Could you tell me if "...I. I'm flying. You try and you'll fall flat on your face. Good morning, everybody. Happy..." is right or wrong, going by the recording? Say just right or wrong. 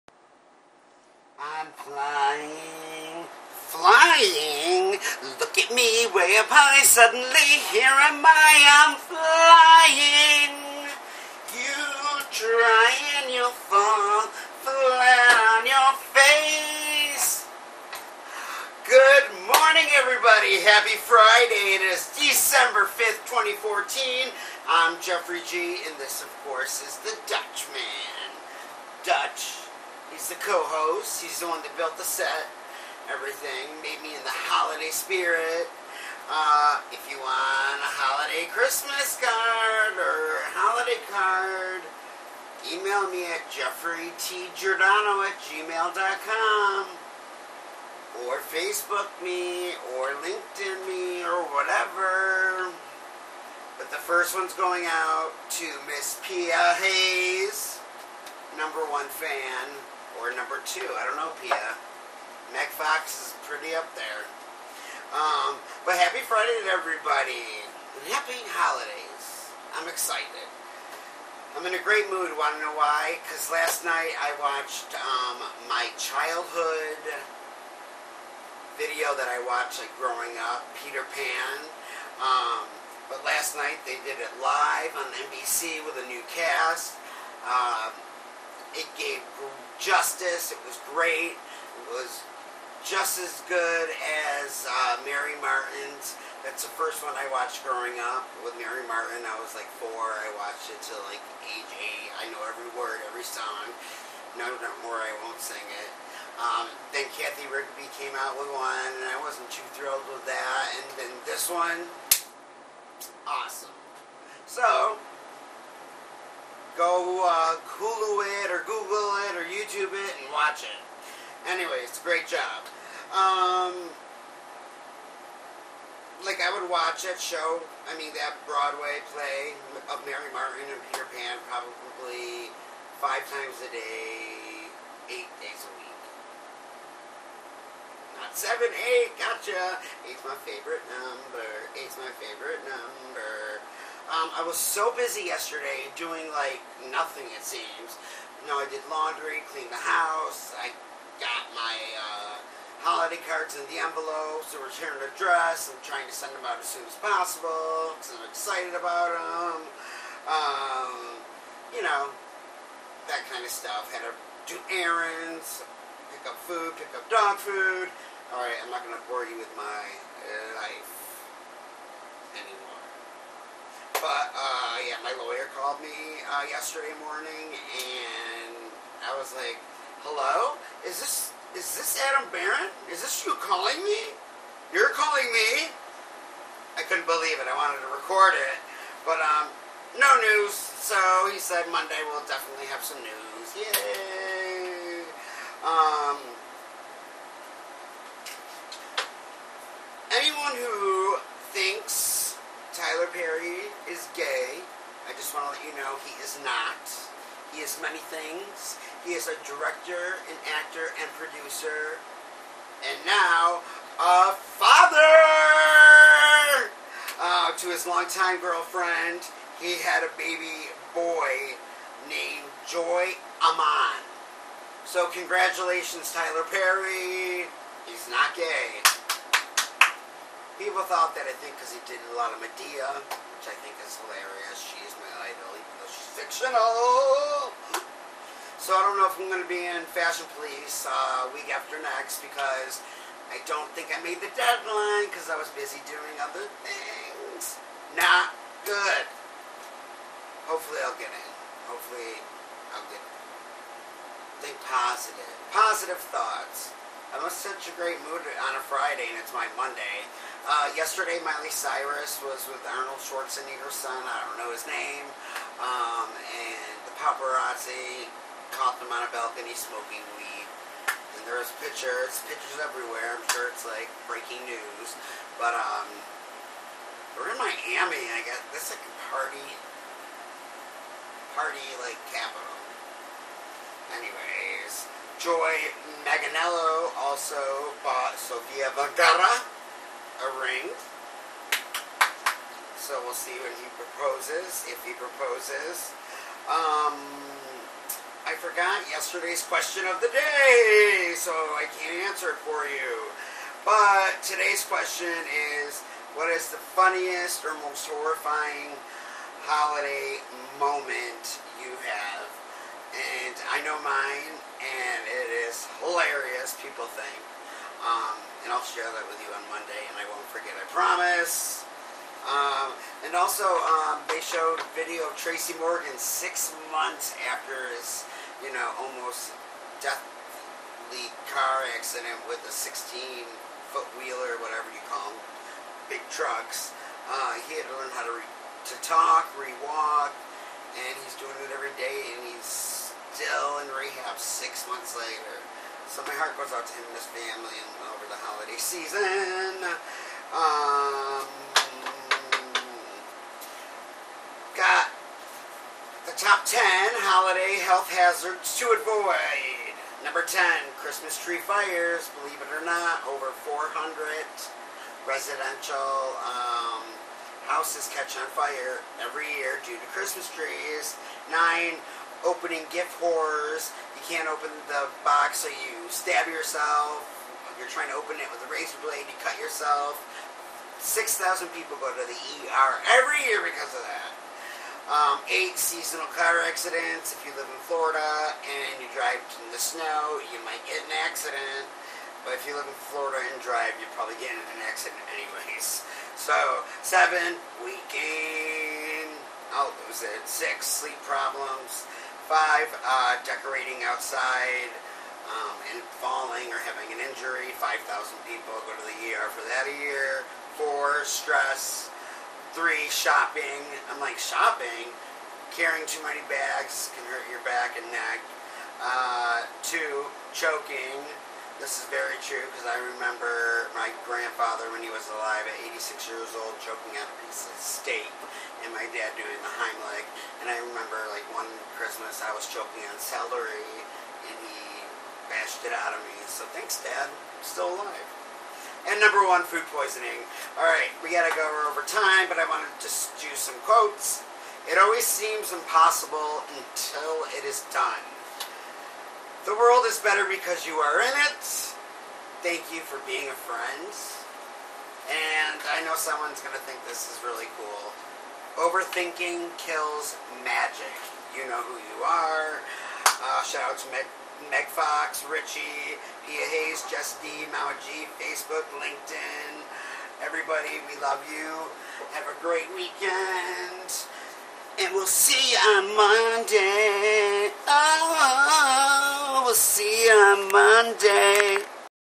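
right.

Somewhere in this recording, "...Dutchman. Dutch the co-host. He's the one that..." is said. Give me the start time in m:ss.
0:27.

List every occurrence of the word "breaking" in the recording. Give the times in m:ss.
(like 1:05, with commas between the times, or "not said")
4:34.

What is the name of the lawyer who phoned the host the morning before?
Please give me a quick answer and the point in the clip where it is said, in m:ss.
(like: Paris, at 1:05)
Adam Barron, at 3:02.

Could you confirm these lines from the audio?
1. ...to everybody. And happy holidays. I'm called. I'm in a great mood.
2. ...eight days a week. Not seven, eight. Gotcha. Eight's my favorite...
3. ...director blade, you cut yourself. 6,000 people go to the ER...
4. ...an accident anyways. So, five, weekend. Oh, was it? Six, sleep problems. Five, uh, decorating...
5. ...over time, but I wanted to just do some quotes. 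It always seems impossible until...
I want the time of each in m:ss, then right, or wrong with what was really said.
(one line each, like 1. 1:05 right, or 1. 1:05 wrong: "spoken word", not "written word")
1. 1:06 wrong: "excited", not "called"
2. 2:15 right
3. 6:18 wrong: "razor", not "director"
4. 6:34 wrong: "seven", not "five"
5. 7:21 right.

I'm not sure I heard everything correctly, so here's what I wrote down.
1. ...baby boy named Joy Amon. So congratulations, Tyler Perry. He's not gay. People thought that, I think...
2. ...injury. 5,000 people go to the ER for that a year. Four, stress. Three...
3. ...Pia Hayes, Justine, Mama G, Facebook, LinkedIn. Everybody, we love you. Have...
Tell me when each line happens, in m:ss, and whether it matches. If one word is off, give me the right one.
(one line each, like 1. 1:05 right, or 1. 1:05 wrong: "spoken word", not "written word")
1. 3:40 right
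2. 6:47 right
3. 7:46 right.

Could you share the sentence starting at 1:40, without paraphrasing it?
I watched it till like age eight.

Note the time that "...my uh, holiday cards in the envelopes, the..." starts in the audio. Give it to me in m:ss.
2:31.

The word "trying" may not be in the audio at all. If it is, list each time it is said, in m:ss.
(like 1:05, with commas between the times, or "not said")
2:35, 6:17.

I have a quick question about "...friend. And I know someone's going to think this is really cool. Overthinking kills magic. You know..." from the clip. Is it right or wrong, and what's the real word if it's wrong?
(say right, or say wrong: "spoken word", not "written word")
right.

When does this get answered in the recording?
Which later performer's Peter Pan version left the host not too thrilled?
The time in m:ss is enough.
1:47.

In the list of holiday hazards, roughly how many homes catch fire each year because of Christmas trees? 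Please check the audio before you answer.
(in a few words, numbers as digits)
400.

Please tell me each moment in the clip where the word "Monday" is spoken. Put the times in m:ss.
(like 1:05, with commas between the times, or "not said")
3:11, 4:19, 5:19, 7:55, 8:00.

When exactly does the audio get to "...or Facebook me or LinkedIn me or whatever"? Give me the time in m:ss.
0:48.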